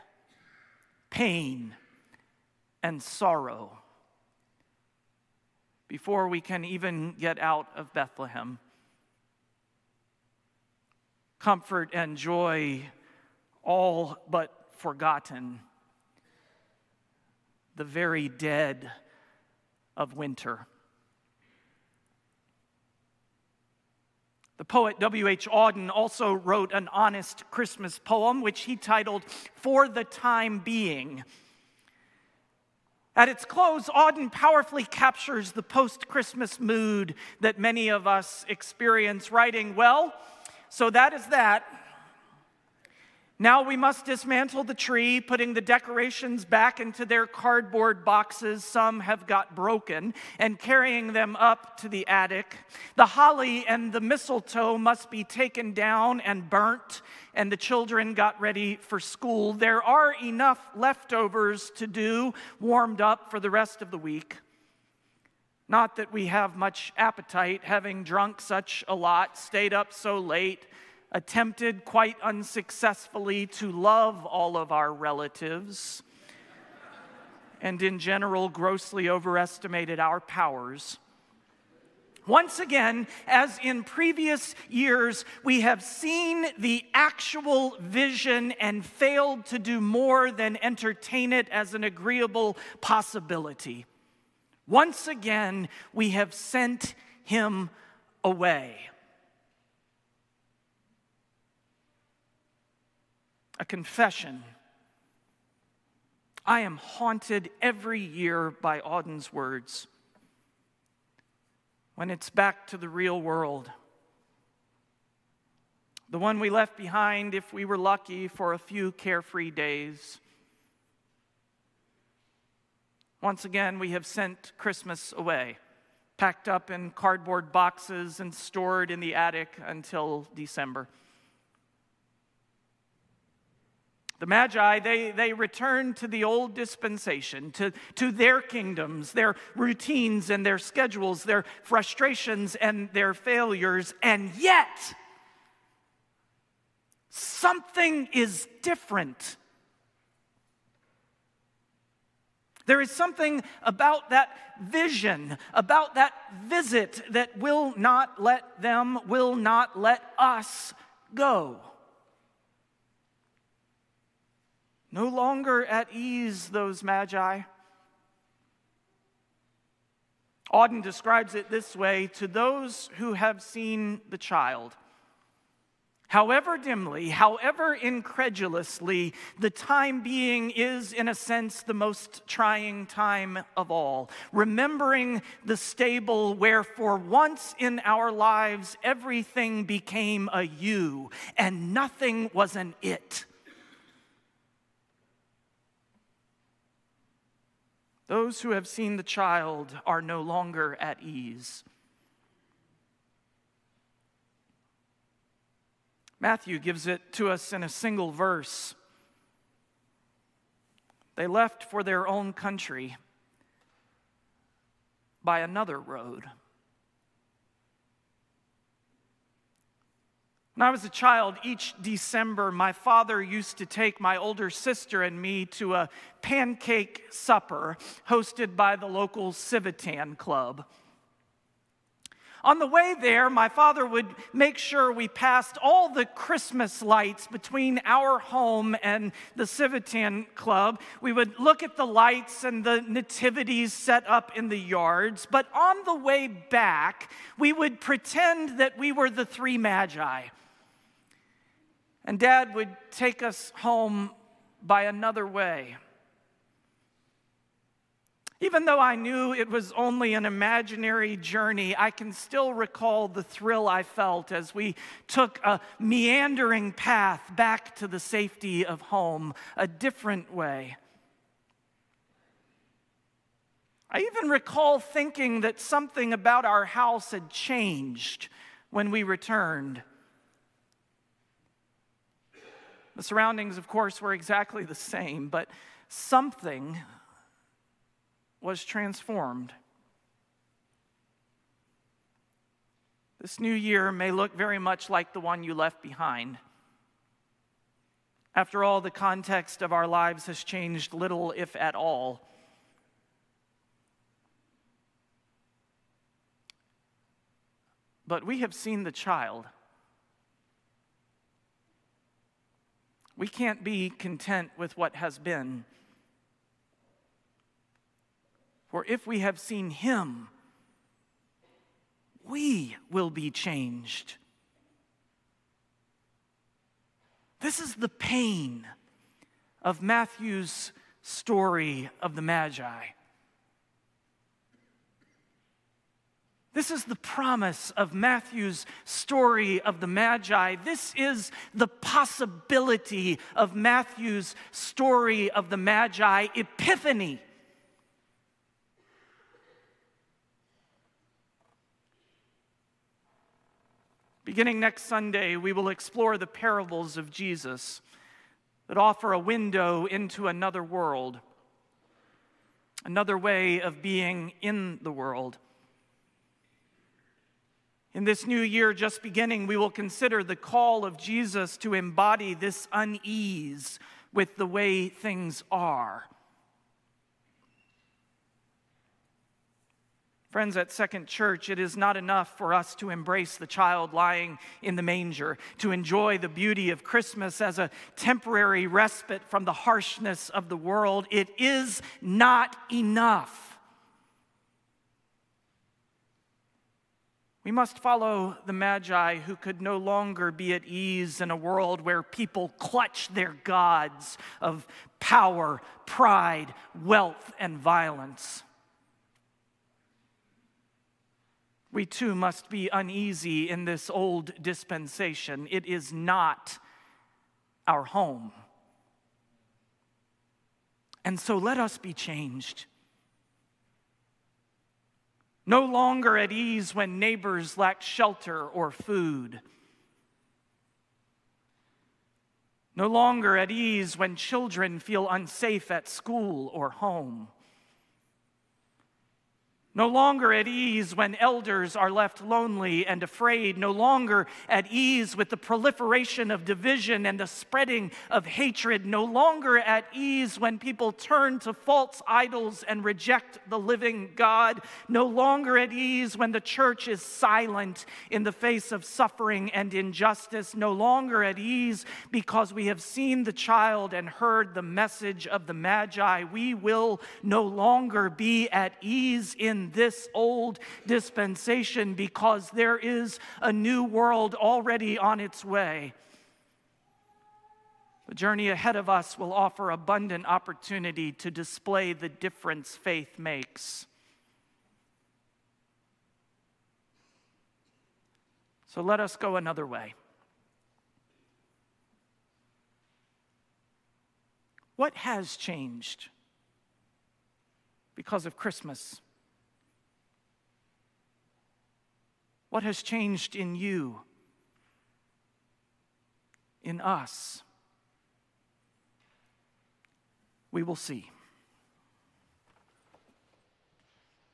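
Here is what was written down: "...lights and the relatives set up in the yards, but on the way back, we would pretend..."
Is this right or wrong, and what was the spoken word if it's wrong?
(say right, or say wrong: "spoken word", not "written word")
wrong: "nativities", not "relatives".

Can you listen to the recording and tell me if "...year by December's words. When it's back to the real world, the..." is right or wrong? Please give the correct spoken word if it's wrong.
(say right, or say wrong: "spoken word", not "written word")
wrong: "Auden", not "December".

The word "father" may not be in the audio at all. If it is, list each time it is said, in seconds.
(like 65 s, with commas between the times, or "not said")
222 s, 233 s.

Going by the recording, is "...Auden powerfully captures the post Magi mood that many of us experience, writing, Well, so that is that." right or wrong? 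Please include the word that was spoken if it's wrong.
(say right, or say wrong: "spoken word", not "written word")
wrong: "Christmas", not "Magi".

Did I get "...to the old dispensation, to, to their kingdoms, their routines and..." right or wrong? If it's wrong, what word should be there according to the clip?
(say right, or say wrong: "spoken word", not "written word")
right.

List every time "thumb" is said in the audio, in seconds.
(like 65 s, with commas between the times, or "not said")
not said.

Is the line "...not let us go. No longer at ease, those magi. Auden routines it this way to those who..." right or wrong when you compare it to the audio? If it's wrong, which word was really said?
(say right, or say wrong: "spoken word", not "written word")
wrong: "describes", not "routines".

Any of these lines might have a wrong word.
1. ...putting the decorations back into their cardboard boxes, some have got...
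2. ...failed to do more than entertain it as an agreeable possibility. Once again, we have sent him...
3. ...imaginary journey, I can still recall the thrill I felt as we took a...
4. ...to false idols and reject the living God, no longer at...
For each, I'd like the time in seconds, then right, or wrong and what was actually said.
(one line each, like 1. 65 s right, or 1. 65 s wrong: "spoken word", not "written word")
1. 45 s right
2. 88 s right
3. 260 s right
4. 451 s right.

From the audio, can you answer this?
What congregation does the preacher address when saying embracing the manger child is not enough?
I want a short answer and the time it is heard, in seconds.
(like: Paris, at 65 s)
Second Church, at 380 s.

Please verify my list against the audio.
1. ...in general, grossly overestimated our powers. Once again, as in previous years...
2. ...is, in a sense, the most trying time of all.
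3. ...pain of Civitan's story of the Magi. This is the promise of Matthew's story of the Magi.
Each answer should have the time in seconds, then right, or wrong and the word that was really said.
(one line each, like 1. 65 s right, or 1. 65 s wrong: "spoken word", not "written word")
1. 77 s right
2. 180 s right
3. 327 s wrong: "Matthew", not "Civitan".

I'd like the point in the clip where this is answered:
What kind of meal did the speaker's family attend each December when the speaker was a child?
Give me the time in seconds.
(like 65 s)
226 s.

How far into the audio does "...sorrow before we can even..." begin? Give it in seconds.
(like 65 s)
3 s.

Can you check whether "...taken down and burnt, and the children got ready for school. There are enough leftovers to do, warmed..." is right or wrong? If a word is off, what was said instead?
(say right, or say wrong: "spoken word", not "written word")
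right.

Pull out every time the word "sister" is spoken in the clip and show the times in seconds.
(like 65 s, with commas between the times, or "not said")
224 s.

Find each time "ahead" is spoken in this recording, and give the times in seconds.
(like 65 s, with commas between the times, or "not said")
478 s.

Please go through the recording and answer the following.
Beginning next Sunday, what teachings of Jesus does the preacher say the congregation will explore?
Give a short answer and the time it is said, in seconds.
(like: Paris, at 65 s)
parables, at 356 s.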